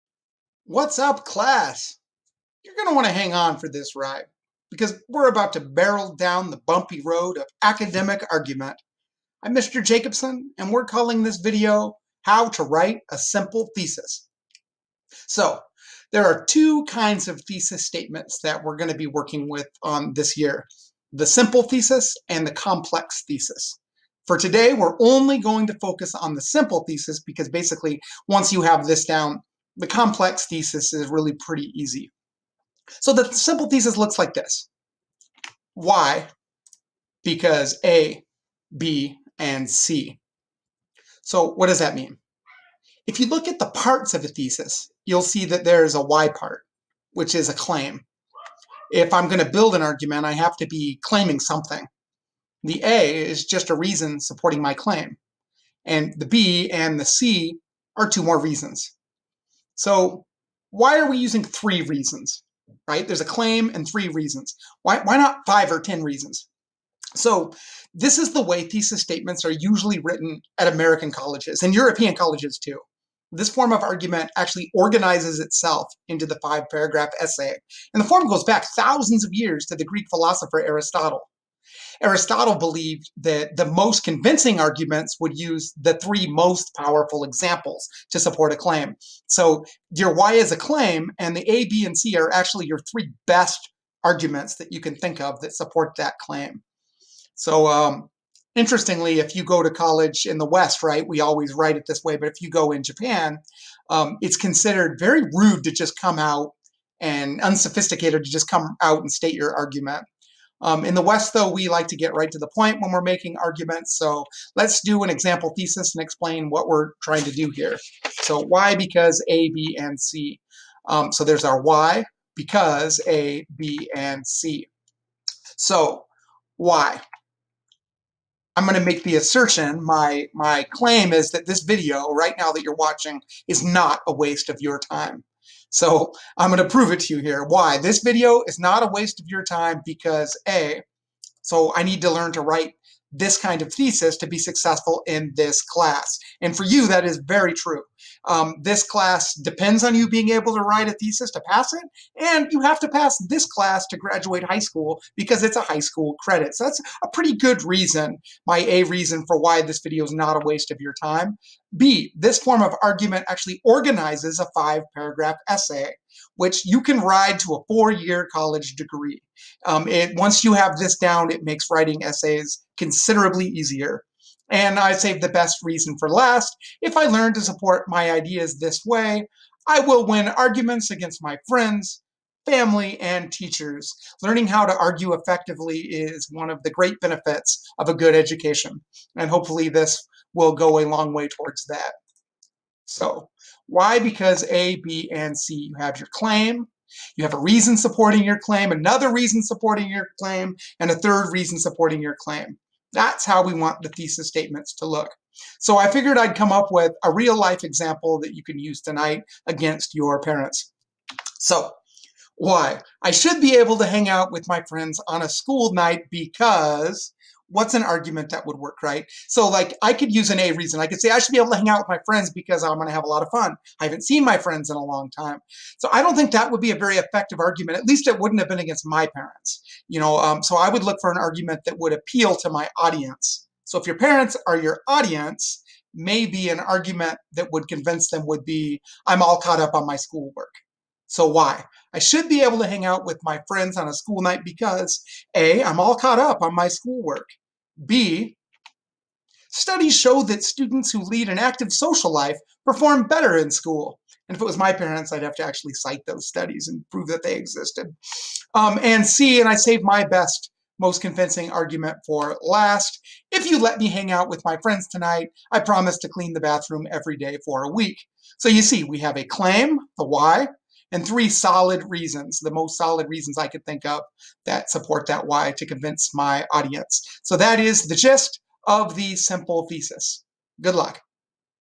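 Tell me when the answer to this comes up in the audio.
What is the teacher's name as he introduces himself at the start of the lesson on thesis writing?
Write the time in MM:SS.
00:09.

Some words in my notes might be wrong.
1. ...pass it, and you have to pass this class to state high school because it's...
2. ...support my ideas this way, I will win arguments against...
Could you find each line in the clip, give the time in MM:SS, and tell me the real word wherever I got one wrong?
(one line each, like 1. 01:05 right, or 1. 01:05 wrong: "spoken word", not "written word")
1. 02:31 wrong: "graduate", not "state"
2. 02:57 right.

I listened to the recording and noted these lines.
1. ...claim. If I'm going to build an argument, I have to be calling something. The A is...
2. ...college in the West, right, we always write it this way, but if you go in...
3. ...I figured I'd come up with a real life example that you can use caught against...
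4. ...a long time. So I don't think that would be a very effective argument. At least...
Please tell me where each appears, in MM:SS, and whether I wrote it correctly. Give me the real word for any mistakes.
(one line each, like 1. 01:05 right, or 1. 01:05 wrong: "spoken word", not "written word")
1. 00:47 wrong: "claiming", not "calling"
2. 01:39 right
3. 03:25 wrong: "tonight", not "caught"
4. 03:44 right.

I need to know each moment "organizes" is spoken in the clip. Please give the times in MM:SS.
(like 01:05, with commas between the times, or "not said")
01:14, 02:43.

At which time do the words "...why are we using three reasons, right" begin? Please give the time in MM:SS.
01:00.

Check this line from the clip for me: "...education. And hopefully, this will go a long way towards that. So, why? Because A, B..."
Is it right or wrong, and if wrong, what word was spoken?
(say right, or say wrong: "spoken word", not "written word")
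right.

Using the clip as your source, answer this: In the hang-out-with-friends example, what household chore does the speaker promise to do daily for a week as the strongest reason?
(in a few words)
clean the bathroom.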